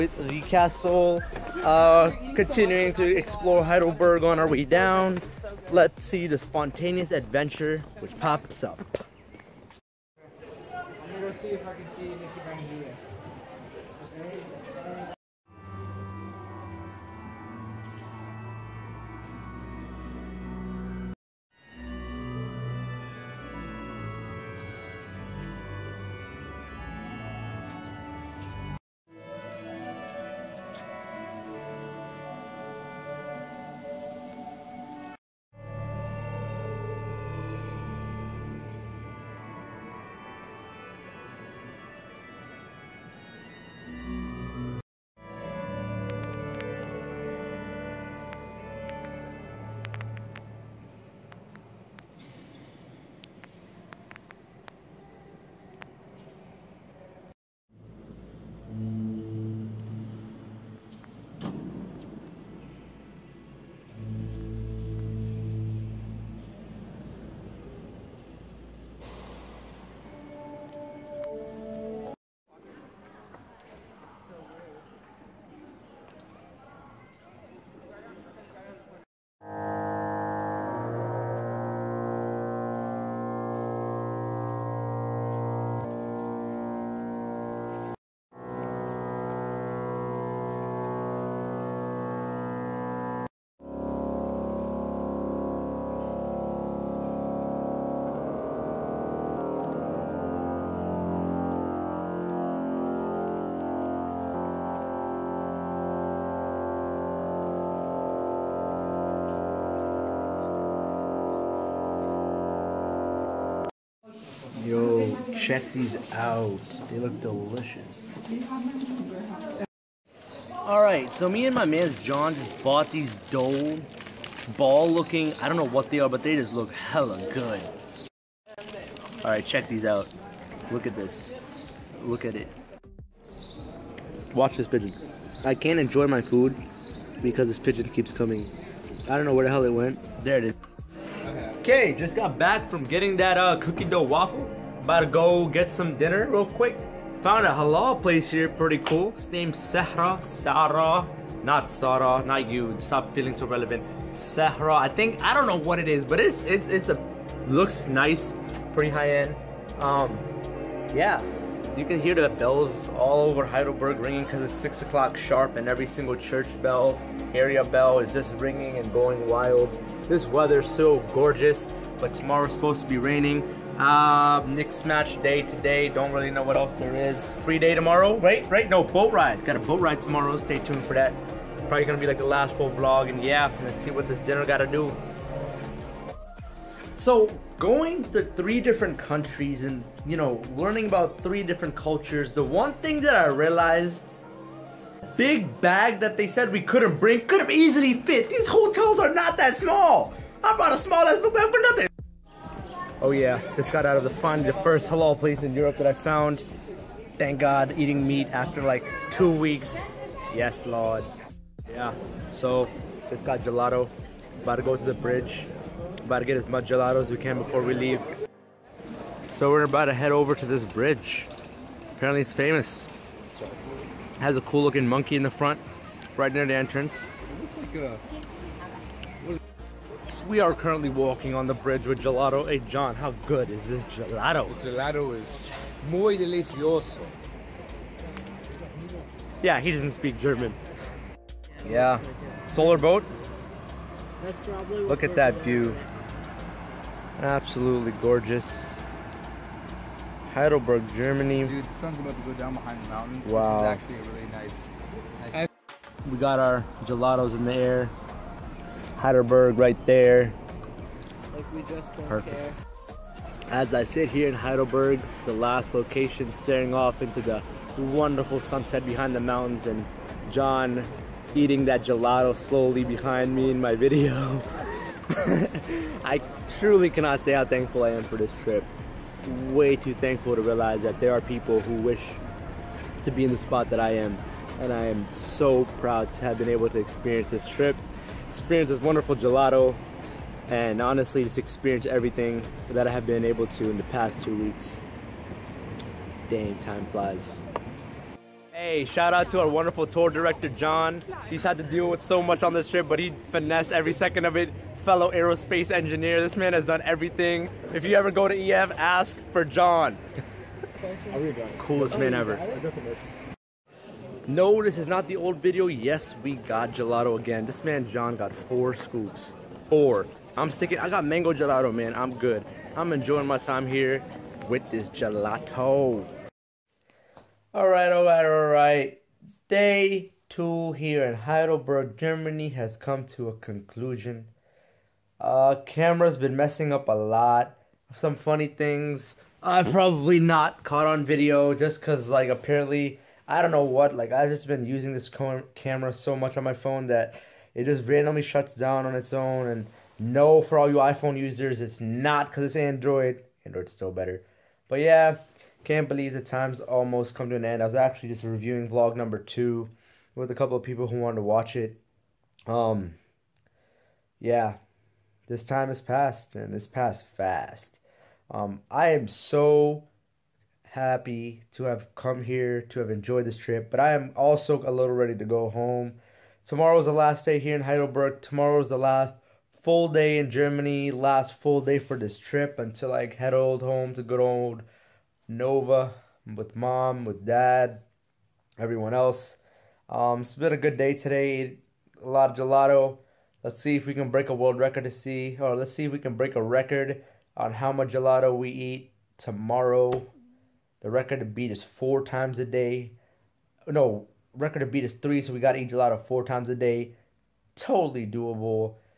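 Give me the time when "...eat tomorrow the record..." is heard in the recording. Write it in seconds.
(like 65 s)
398 s.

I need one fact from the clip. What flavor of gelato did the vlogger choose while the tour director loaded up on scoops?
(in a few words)
Mango.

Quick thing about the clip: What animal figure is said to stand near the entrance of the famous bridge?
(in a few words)
Monkey.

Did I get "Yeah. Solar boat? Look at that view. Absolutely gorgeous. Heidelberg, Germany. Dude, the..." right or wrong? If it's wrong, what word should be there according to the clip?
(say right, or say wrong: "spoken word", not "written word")
right.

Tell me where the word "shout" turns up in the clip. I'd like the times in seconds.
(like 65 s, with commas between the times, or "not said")
298 s.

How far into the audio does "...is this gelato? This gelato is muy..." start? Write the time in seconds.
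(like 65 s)
233 s.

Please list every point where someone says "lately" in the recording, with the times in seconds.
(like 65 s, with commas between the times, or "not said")
not said.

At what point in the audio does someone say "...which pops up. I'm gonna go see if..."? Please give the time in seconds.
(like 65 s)
8 s.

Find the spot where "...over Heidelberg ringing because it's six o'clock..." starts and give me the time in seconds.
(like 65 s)
163 s.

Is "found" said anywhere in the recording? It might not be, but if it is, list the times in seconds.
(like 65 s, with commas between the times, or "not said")
147 s, 205 s.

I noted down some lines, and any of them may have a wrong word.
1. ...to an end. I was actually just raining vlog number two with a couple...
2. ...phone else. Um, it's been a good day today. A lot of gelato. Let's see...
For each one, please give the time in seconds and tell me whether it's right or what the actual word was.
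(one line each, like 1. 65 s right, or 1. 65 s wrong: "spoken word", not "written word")
1. 357 s wrong: "reviewing", not "raining"
2. 388 s wrong: "everyone", not "phone".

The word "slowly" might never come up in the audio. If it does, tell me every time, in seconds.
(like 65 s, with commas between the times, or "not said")
272 s.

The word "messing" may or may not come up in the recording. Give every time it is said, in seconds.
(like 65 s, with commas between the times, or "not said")
336 s.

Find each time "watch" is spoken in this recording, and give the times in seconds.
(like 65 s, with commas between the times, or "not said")
134 s, 361 s.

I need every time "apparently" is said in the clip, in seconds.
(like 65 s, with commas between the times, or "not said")
221 s, 342 s.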